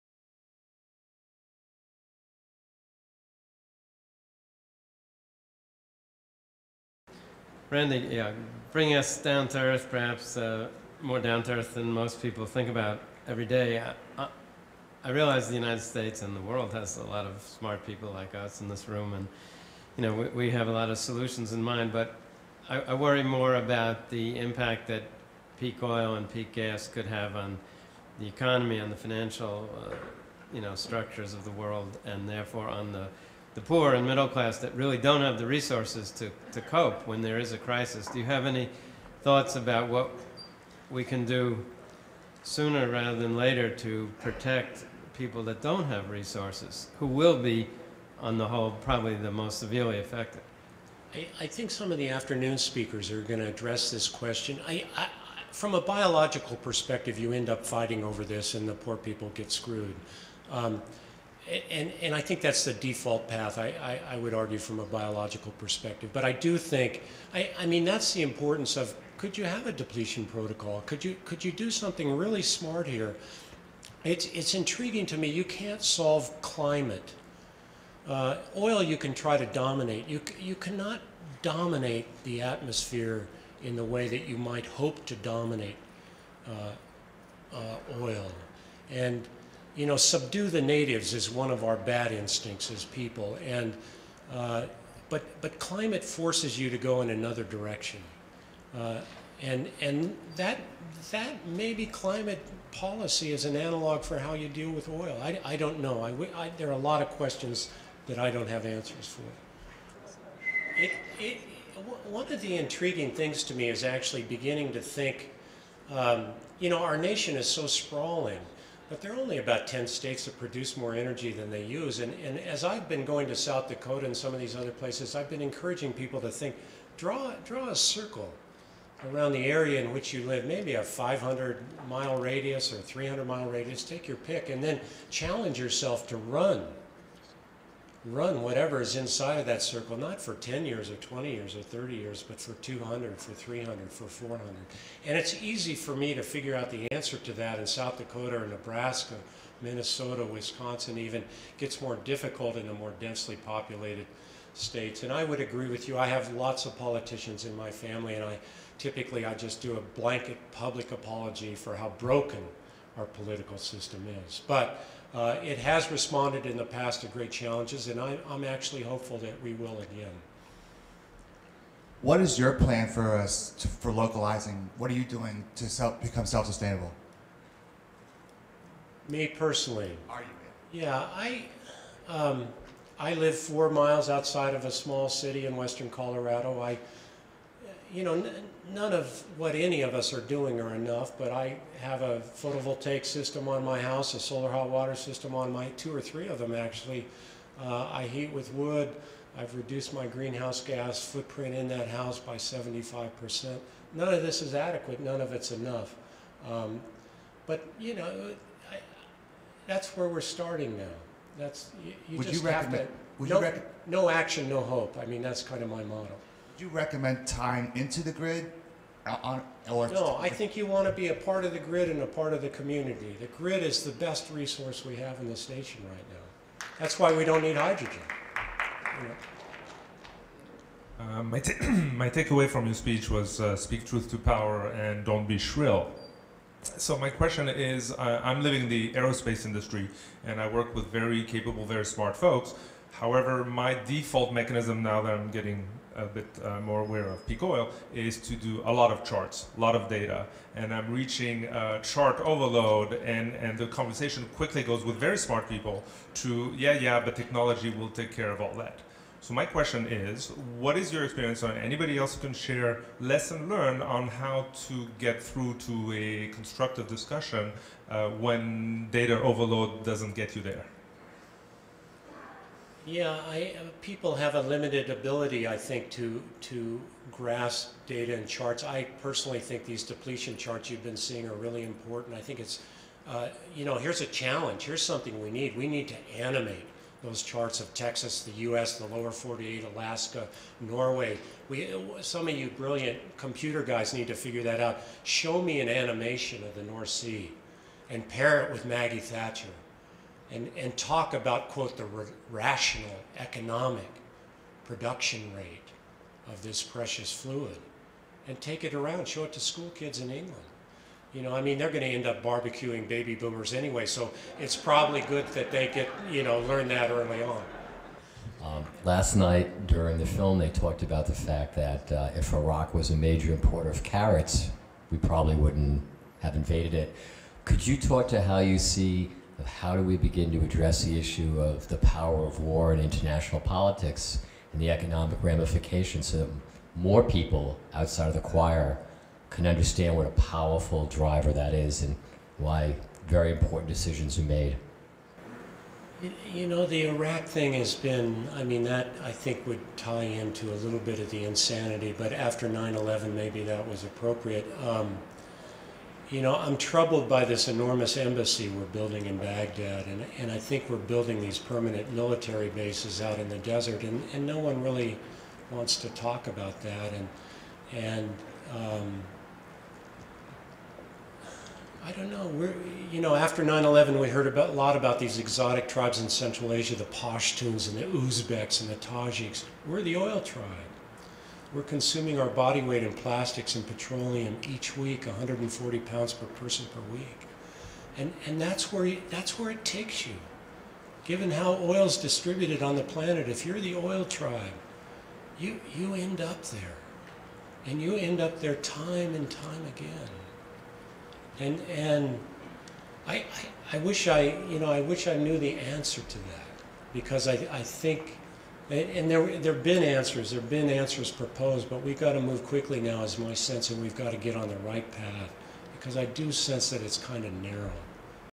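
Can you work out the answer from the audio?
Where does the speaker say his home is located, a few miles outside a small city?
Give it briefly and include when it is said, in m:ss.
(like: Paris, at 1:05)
western Colorado, at 3:05.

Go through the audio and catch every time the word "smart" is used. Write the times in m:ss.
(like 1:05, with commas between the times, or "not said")
0:17, 1:12, 4:01, 4:15.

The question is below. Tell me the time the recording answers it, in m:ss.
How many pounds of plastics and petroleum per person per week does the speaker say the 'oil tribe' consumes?
6:25.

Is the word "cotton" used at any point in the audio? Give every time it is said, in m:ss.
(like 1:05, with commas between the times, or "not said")
not said.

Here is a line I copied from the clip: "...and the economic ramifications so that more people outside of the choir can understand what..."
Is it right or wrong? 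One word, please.
right.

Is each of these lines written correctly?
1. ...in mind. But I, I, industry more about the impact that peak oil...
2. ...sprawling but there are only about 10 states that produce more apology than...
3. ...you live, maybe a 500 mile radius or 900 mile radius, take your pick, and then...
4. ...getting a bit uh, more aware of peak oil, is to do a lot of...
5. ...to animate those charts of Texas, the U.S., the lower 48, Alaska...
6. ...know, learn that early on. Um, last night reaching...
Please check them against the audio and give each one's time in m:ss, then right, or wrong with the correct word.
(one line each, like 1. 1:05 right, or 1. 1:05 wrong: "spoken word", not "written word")
1. 0:21 wrong: "worry", not "industry"
2. 1:57 wrong: "energy", not "apology"
3. 2:10 wrong: "300", not "900"
4. 4:05 right
5. 4:45 right
6. 5:16 wrong: "during", not "reaching".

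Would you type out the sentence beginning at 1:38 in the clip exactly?
Uh, and and that, that maybe climate policy is an analog for how you deal with oil.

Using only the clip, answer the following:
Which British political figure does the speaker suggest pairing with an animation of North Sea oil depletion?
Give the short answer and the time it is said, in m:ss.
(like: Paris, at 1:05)
Maggie Thatcher, at 4:58.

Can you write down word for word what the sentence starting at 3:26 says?
Um, but, you know, I, that's where we're starting now.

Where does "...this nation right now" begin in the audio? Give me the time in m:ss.
3:45.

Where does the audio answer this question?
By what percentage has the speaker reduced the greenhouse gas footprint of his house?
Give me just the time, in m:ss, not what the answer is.
3:22.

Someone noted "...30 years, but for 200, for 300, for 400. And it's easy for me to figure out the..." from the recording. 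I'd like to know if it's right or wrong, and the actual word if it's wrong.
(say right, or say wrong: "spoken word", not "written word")
right.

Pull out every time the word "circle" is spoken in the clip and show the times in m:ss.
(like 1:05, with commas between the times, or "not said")
2:07, 2:19.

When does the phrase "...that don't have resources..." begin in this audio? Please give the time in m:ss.
0:45.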